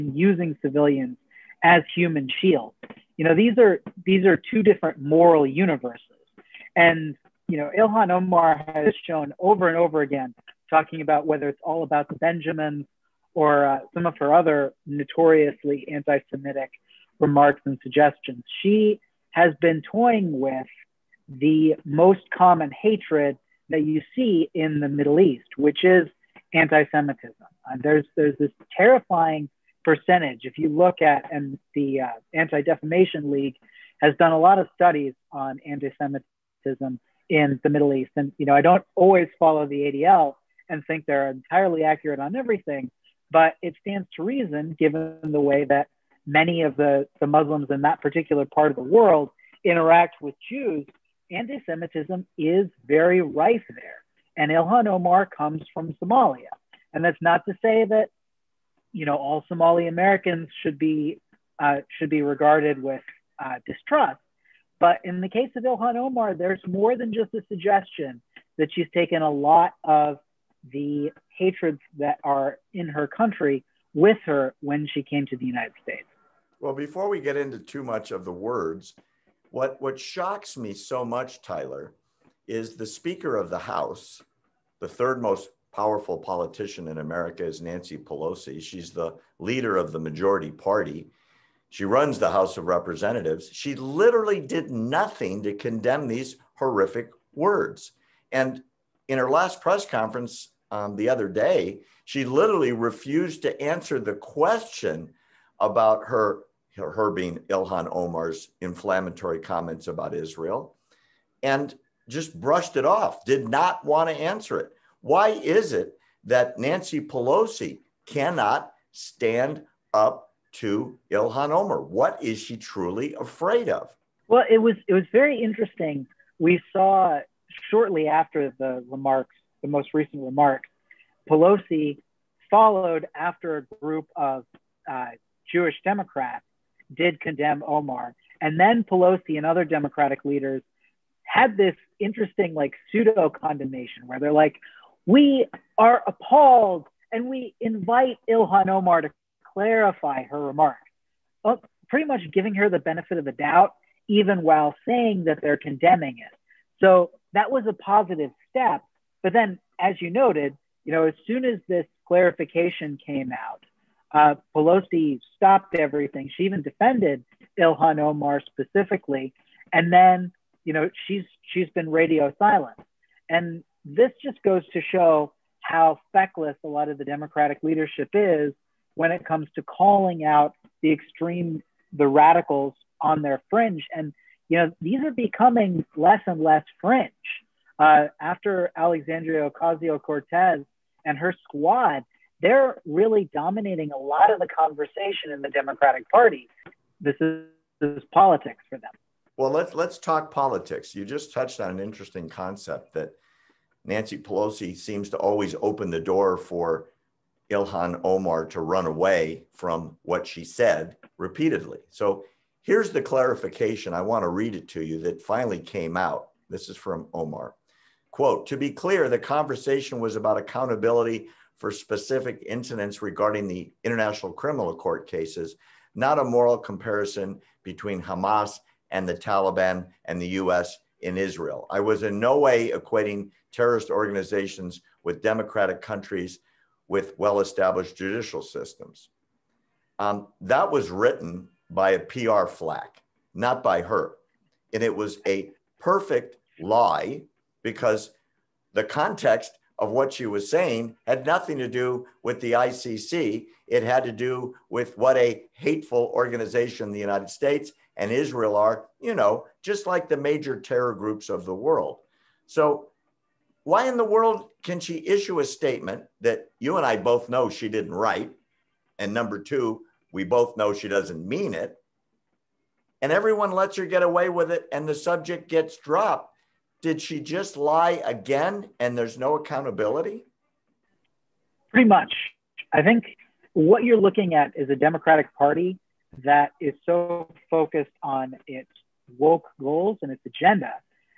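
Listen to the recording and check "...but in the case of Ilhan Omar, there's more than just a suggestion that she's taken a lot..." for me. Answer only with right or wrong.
right.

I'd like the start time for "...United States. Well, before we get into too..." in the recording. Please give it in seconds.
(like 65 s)
75 s.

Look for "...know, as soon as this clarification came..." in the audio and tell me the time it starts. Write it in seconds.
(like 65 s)
160 s.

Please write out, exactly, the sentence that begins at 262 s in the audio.
So why in the world can she issue a statement that you and I both know she didn't write?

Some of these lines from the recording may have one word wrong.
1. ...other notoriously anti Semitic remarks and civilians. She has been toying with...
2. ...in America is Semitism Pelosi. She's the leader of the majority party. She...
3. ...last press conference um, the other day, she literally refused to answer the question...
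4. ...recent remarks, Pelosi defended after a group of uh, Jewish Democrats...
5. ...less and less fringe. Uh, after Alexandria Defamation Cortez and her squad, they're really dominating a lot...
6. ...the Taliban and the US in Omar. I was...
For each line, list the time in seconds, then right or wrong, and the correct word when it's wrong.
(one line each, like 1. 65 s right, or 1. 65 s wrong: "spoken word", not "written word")
1. 14 s wrong: "suggestions", not "civilians"
2. 86 s wrong: "Nancy", not "Semitism"
3. 99 s right
4. 129 s wrong: "followed", not "defended"
5. 185 s wrong: "Ocasio", not "Defamation"
6. 229 s wrong: "Israel", not "Omar".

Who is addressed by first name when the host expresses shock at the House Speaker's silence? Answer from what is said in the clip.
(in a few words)
Tyler.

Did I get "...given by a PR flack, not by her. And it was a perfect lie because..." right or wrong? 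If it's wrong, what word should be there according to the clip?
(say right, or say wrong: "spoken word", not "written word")
wrong: "written", not "given".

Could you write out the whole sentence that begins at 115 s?
Why is it that Nancy Pelosi cannot stand up to Ilhan Omar.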